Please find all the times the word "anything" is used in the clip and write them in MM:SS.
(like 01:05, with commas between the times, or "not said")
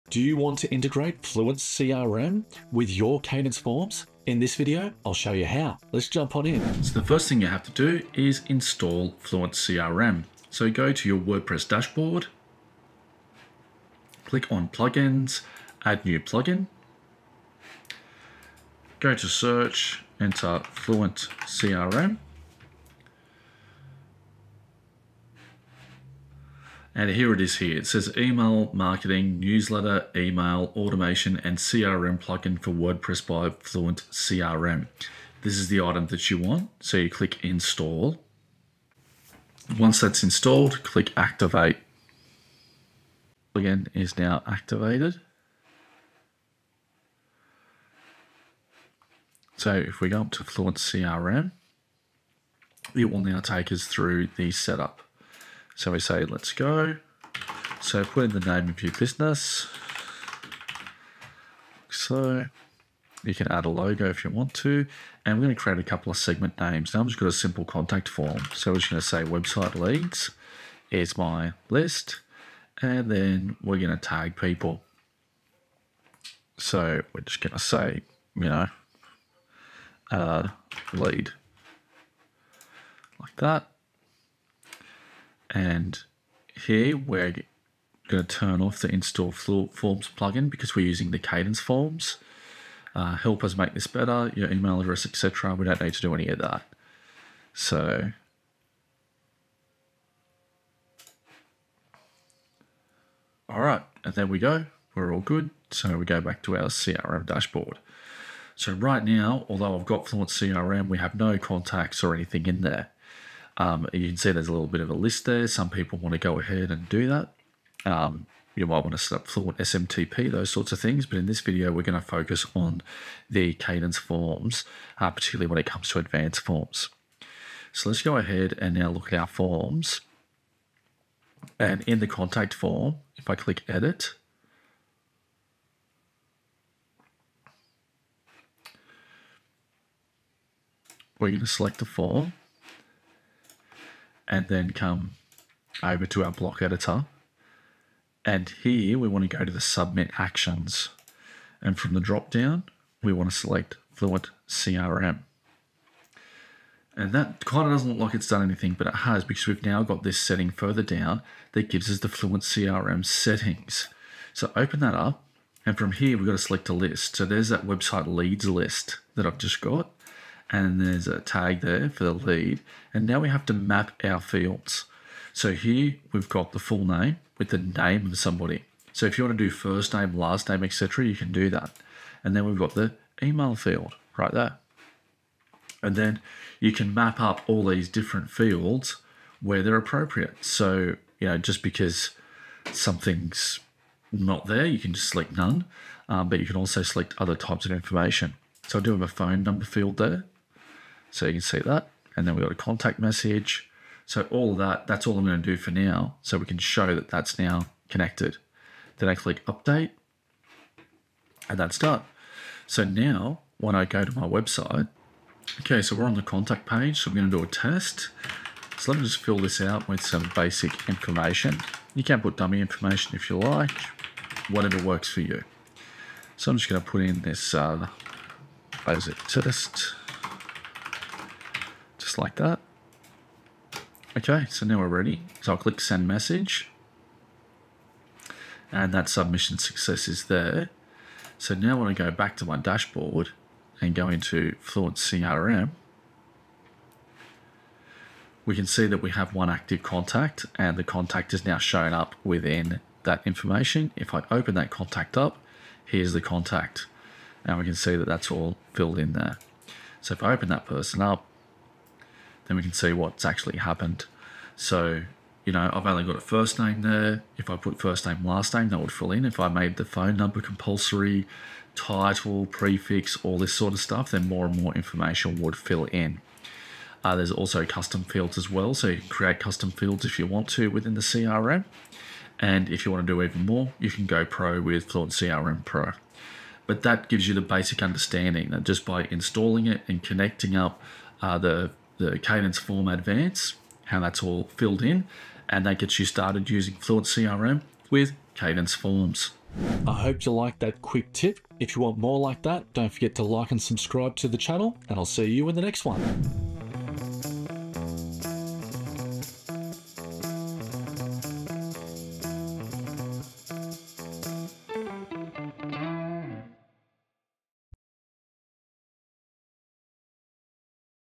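01:52, 02:38.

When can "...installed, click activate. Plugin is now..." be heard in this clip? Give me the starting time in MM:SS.
00:40.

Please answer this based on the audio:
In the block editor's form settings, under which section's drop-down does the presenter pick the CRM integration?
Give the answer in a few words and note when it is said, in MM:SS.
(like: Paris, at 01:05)
submit actions, at 02:29.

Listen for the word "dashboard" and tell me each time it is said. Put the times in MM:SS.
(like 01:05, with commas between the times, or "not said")
00:11, 01:47, 04:02.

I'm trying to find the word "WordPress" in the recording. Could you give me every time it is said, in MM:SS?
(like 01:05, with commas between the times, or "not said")
00:11, 00:32.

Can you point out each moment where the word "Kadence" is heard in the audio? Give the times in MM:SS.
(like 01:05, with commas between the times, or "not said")
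00:03, 01:31, 02:03, 04:52, 04:58.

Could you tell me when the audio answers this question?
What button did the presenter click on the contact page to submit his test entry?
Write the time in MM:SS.
03:55.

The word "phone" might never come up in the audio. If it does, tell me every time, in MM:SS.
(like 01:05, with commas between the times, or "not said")
03:19, 04:29.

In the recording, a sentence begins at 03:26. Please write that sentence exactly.
So we can show that that's now connected.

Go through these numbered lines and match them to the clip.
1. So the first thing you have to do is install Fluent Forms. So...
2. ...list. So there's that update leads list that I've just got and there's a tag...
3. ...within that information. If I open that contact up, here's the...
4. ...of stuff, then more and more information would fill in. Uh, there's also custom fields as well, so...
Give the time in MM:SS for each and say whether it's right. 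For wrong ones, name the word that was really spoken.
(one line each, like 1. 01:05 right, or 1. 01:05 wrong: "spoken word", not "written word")
1. 00:06 wrong: "CRM", not "Forms"
2. 02:46 wrong: "website", not "update"
3. 04:12 right
4. 04:33 right.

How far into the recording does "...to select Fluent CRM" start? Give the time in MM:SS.
02:33.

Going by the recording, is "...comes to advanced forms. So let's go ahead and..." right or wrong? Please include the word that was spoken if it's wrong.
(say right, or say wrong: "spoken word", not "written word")
right.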